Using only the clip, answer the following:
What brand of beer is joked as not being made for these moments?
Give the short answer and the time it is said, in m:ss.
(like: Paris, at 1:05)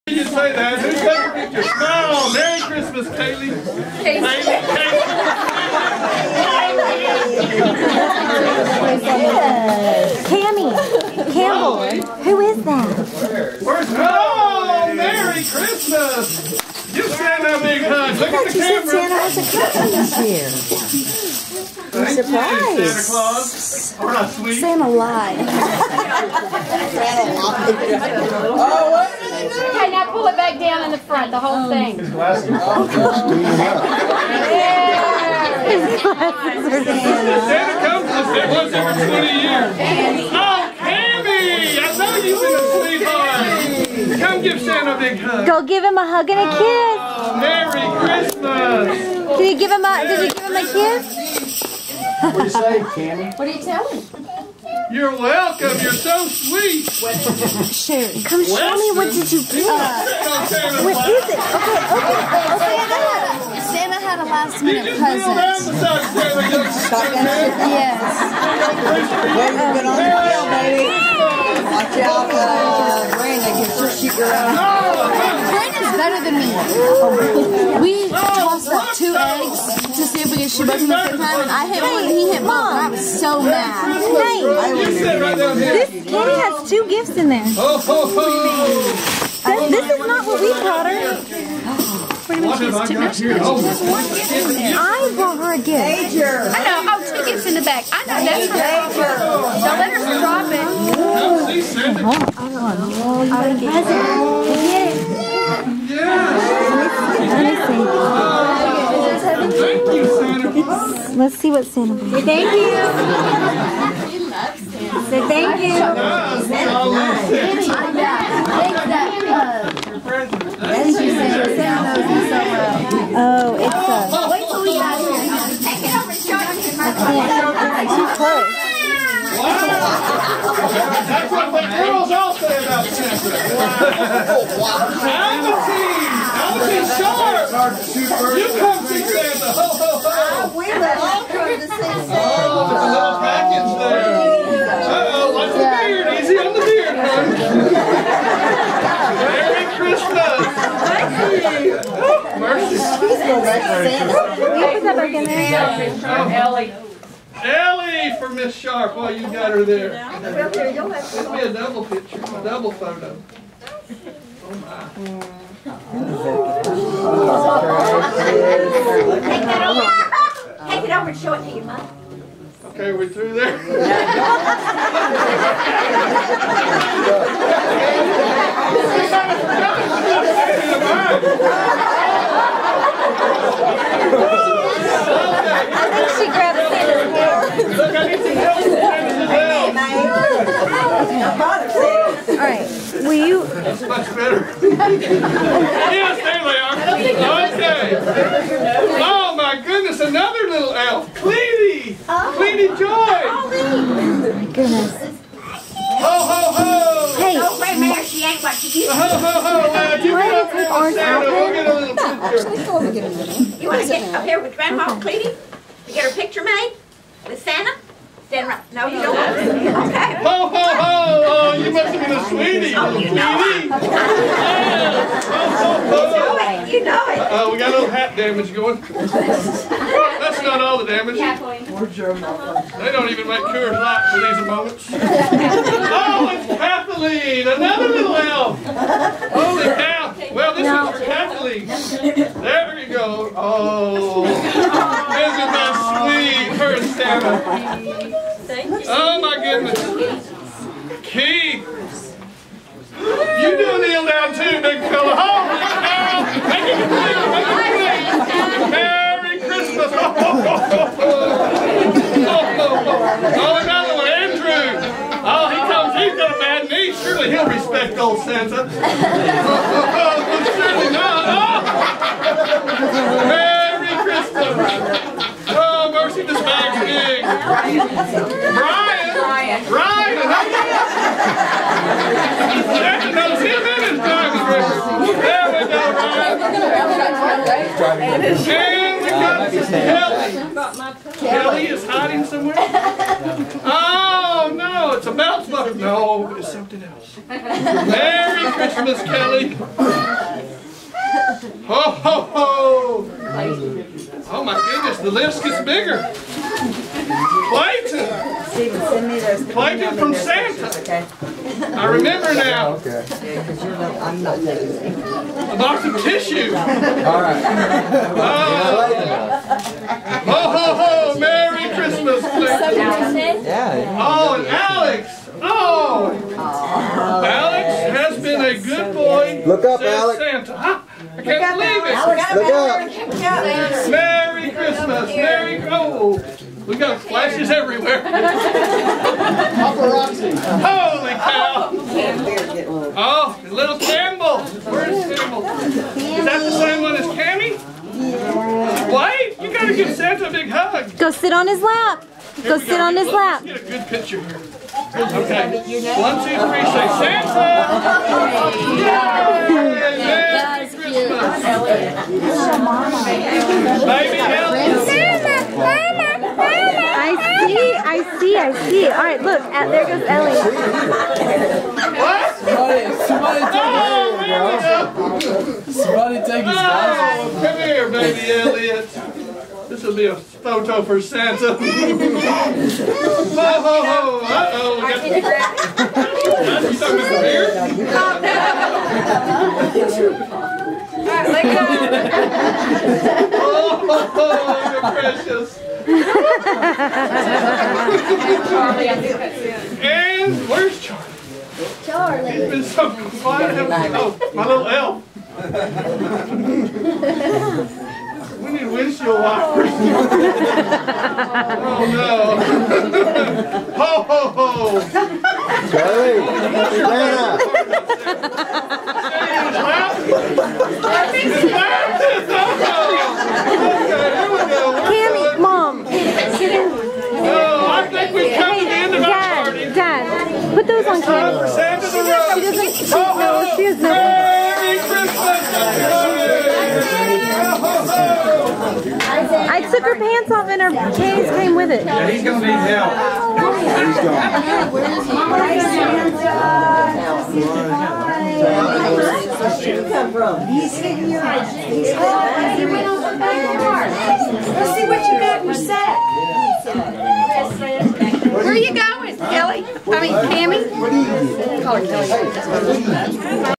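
Coors Light, at 3:53.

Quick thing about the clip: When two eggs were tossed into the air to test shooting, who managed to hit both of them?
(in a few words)
Brandon.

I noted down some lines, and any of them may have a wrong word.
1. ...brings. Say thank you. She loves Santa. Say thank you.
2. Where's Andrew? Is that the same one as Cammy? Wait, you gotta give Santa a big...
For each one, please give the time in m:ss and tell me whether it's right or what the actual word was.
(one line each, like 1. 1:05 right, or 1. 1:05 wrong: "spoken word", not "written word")
1. 1:51 right
2. 5:44 wrong: "Campbell", not "Andrew".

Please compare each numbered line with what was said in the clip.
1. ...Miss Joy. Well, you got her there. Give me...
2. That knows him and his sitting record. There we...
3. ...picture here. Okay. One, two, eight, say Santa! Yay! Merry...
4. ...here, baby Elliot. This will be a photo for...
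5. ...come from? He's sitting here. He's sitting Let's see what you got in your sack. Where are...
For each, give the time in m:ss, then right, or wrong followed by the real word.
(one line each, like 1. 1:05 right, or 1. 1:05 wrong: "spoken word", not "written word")
1. 2:38 wrong: "Sharp", not "Joy"
2. 4:42 wrong: "driving", not "sitting"
3. 5:53 wrong: "three", not "eight"
4. 6:17 right
5. 7:29 right.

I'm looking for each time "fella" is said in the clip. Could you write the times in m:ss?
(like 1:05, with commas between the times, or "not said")
4:14.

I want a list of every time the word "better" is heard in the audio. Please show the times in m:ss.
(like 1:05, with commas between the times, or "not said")
1:16, 3:14.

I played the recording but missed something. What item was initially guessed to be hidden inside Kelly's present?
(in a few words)
belt buckle.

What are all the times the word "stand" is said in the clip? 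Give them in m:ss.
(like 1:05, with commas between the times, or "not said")
0:17, 3:38.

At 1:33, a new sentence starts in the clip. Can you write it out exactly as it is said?
Oh, one gift I brought her a gift.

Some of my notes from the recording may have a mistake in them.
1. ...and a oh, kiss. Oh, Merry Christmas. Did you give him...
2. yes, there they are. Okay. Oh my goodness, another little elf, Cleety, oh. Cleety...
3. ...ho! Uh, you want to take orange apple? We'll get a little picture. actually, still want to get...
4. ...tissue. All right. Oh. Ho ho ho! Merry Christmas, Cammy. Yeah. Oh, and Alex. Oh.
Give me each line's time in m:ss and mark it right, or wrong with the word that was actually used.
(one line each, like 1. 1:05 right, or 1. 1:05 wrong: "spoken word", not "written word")
1. 0:46 right
2. 3:14 right
3. 3:29 right
4. 5:16 wrong: "Clayton", not "Cammy".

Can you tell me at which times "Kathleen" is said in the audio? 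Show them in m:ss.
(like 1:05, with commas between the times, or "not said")
3:56.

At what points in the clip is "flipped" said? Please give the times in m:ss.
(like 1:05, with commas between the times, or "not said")
not said.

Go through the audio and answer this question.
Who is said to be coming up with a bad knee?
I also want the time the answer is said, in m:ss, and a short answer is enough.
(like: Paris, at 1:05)
Andrew, at 4:24.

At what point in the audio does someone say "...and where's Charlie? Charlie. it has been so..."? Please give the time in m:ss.
6:39.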